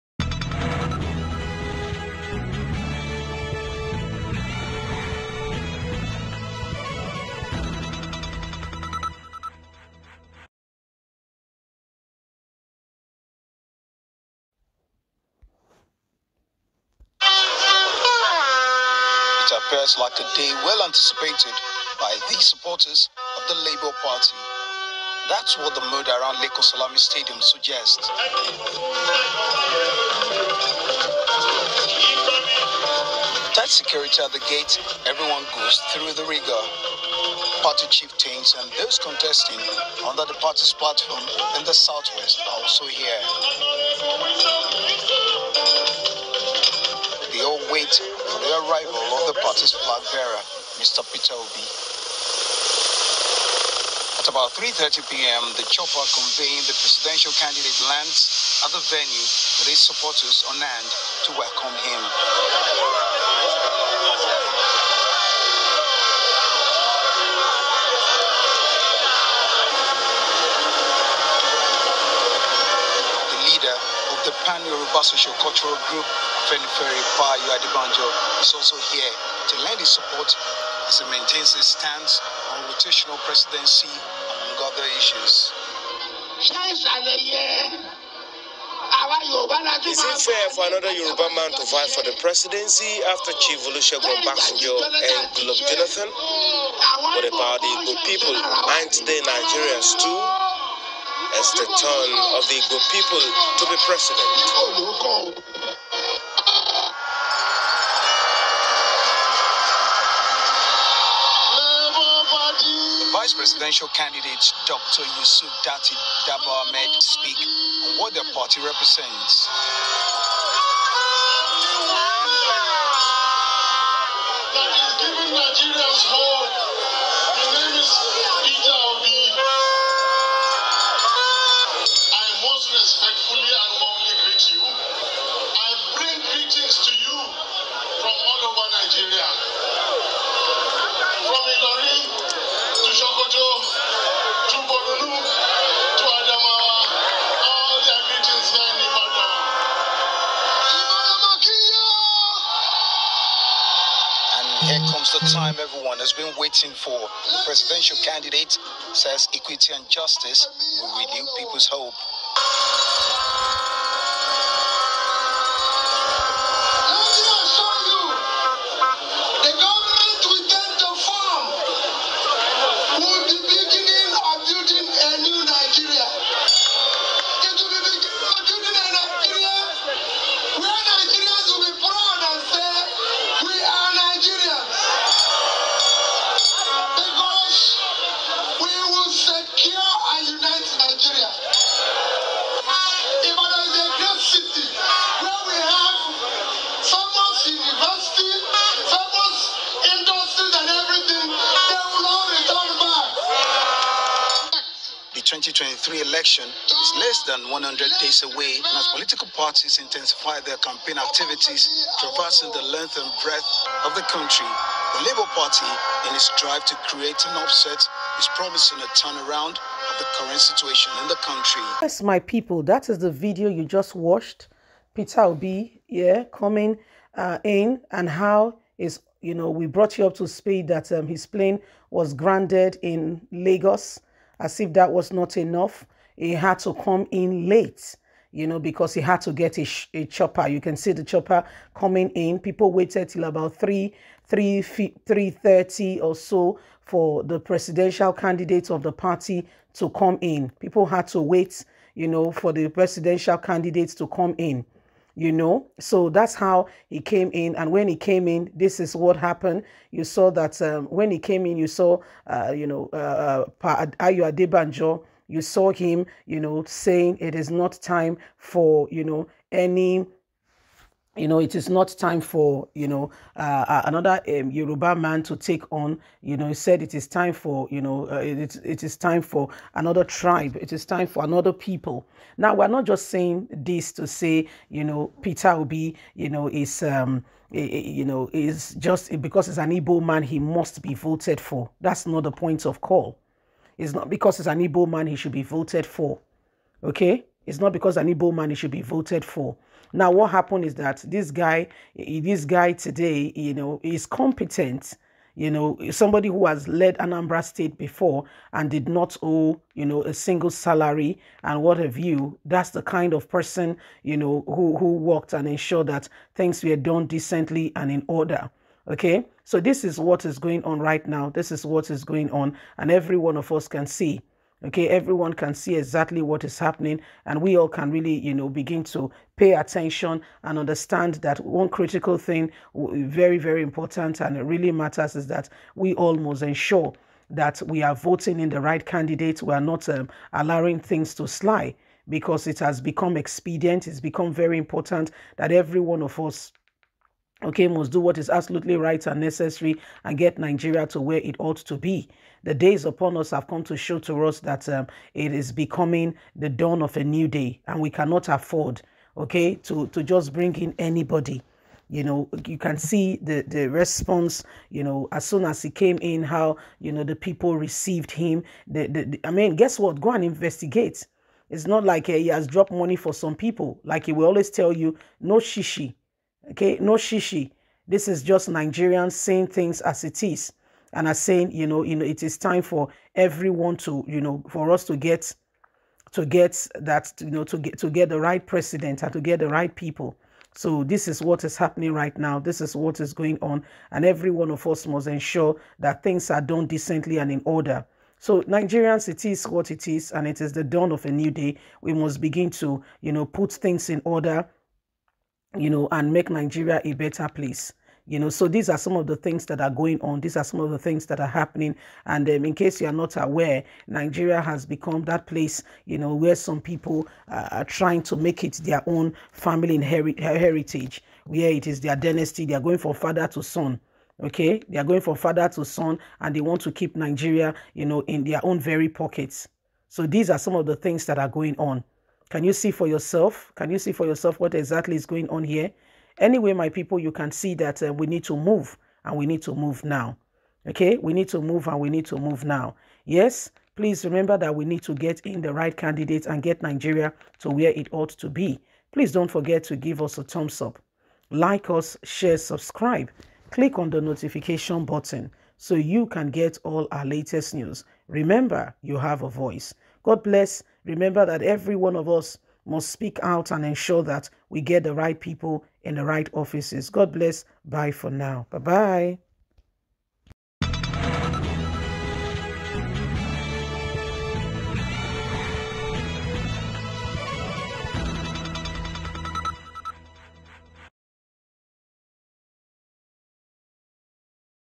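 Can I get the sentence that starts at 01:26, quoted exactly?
Is it fair for another Yoruba man to vie for the presidency after Chief Olusegun Basanjo and Goodluck Jonathan?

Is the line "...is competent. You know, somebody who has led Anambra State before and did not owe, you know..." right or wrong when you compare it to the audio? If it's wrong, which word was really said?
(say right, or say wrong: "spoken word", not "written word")
right.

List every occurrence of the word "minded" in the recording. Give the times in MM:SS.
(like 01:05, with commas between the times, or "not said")
not said.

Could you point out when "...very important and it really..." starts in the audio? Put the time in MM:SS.
05:33.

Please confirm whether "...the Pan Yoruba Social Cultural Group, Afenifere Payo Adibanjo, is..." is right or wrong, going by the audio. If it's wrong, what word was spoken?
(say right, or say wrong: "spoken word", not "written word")
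right.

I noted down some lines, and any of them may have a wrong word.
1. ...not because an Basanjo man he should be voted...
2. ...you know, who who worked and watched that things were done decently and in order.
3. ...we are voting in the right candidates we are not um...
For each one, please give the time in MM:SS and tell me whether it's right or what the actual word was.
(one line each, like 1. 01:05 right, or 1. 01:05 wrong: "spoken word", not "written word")
1. 04:57 wrong: "Igbo", not "Basanjo"
2. 05:14 wrong: "ensured", not "watched"
3. 05:37 right.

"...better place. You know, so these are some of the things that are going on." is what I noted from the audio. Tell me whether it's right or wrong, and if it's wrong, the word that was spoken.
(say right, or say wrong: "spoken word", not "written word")
right.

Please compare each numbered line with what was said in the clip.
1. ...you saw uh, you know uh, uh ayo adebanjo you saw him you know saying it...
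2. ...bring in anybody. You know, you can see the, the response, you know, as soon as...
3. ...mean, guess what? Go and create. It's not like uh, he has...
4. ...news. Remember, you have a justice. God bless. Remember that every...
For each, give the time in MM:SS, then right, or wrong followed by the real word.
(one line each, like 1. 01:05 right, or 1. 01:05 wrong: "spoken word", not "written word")
1. 04:21 right
2. 06:00 right
3. 06:09 wrong: "investigate", not "create"
4. 07:37 wrong: "voice", not "justice".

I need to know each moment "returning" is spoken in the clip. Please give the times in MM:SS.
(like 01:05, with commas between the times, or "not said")
not said.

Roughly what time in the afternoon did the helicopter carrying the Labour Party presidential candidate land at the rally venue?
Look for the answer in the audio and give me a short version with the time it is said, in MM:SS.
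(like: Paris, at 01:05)
3:30 p.m., at 00:54.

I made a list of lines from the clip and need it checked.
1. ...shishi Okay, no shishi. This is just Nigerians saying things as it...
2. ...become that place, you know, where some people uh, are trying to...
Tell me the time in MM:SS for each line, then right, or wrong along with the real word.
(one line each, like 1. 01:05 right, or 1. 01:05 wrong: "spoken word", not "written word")
1. 06:15 right
2. 06:54 right.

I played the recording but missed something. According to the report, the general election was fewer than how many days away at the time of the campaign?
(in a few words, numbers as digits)
100.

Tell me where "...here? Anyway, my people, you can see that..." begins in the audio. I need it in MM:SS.
07:15.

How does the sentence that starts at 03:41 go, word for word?
Yes, my people, that is the video you just watched.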